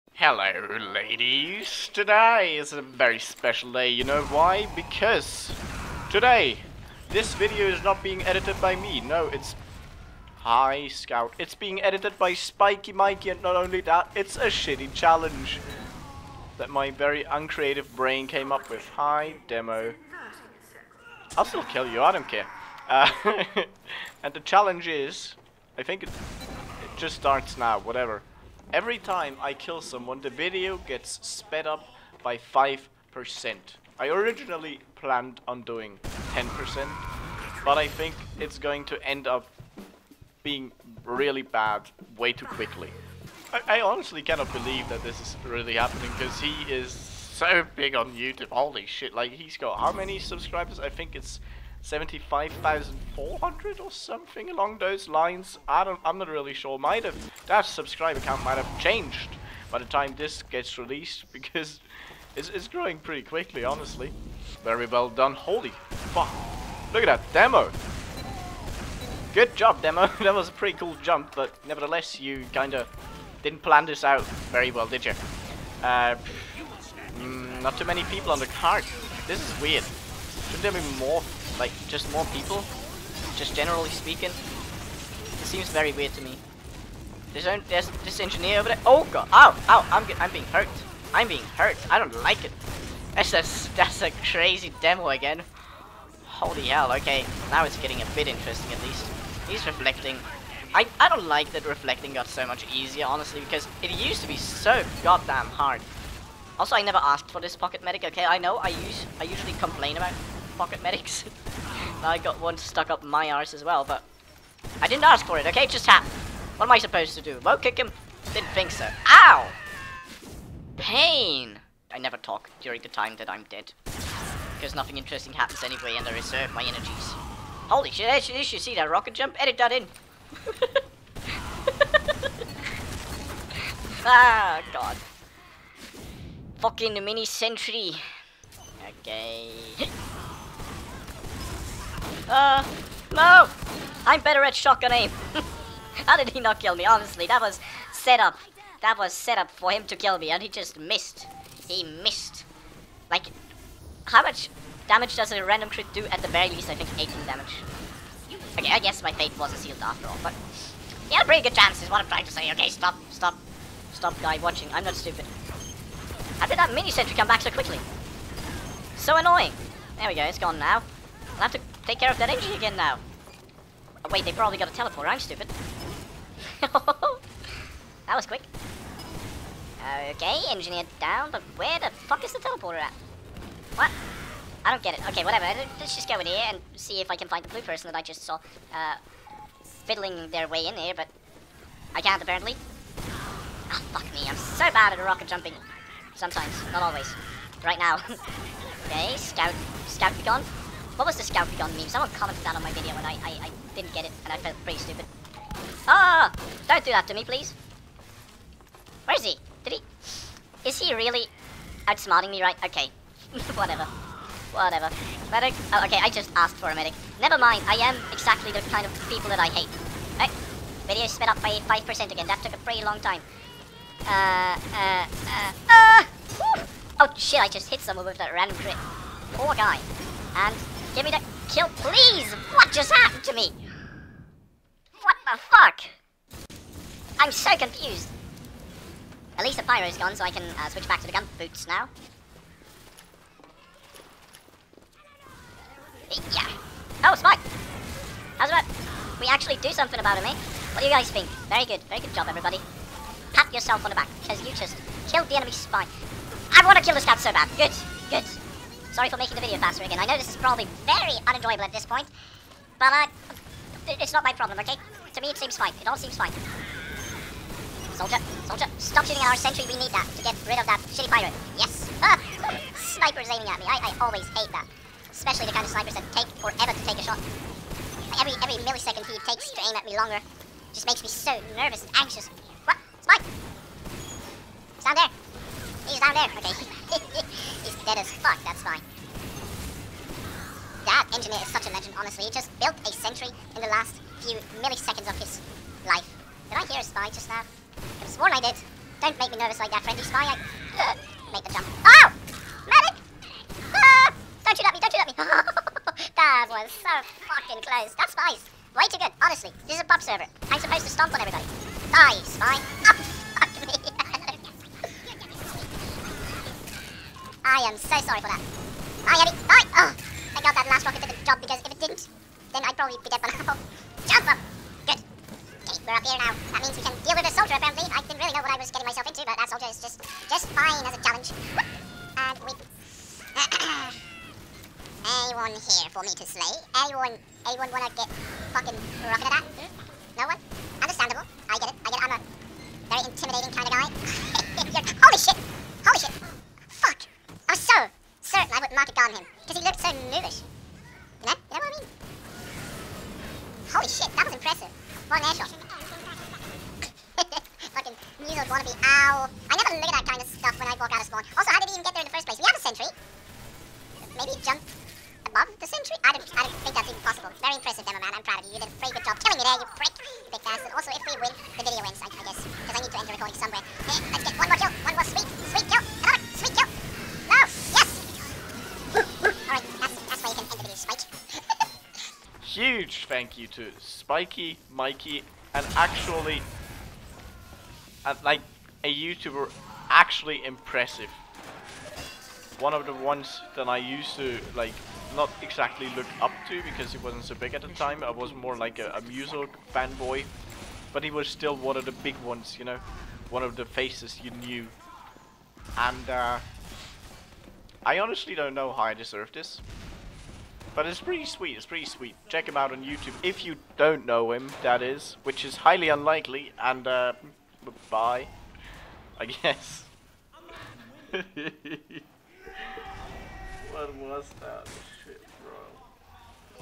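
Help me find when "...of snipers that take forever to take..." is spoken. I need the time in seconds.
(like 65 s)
275 s.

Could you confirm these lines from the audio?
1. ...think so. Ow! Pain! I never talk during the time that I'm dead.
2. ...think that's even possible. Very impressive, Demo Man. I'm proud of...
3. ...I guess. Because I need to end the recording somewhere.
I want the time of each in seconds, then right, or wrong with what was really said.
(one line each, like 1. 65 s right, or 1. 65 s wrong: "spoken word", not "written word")
1. 118 s right
2. 366 s right
3. 372 s right.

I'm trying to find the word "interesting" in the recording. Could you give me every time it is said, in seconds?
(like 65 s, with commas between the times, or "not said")
98 s, 124 s.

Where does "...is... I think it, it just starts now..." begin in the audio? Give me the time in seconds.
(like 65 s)
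24 s.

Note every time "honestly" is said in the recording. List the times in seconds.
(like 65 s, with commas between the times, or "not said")
43 s, 63 s, 103 s, 146 s, 291 s, 309 s, 407 s.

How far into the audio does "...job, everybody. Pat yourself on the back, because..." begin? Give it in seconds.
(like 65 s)
252 s.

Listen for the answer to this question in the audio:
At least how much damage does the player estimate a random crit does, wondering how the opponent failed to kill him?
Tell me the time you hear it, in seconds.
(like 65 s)
156 s.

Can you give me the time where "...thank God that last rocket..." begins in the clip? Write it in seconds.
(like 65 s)
319 s.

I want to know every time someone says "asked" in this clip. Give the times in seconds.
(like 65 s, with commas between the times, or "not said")
107 s, 216 s.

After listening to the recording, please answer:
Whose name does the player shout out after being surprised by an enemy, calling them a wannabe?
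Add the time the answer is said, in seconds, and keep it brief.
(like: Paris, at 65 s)
Von Eschel, at 355 s.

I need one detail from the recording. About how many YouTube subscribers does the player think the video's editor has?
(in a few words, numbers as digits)
75,400.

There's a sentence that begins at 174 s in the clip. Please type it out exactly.
Oh, wait, they probably got a teleporter.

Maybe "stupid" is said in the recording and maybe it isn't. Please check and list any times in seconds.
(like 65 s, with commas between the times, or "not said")
164 s, 175 s, 204 s.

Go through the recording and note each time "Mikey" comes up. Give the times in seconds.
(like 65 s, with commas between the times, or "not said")
12 s, 384 s.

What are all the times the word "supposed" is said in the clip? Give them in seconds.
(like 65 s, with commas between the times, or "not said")
116 s, 310 s.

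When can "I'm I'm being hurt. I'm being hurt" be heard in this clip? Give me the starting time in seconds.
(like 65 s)
89 s.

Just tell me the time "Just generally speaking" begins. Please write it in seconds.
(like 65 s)
83 s.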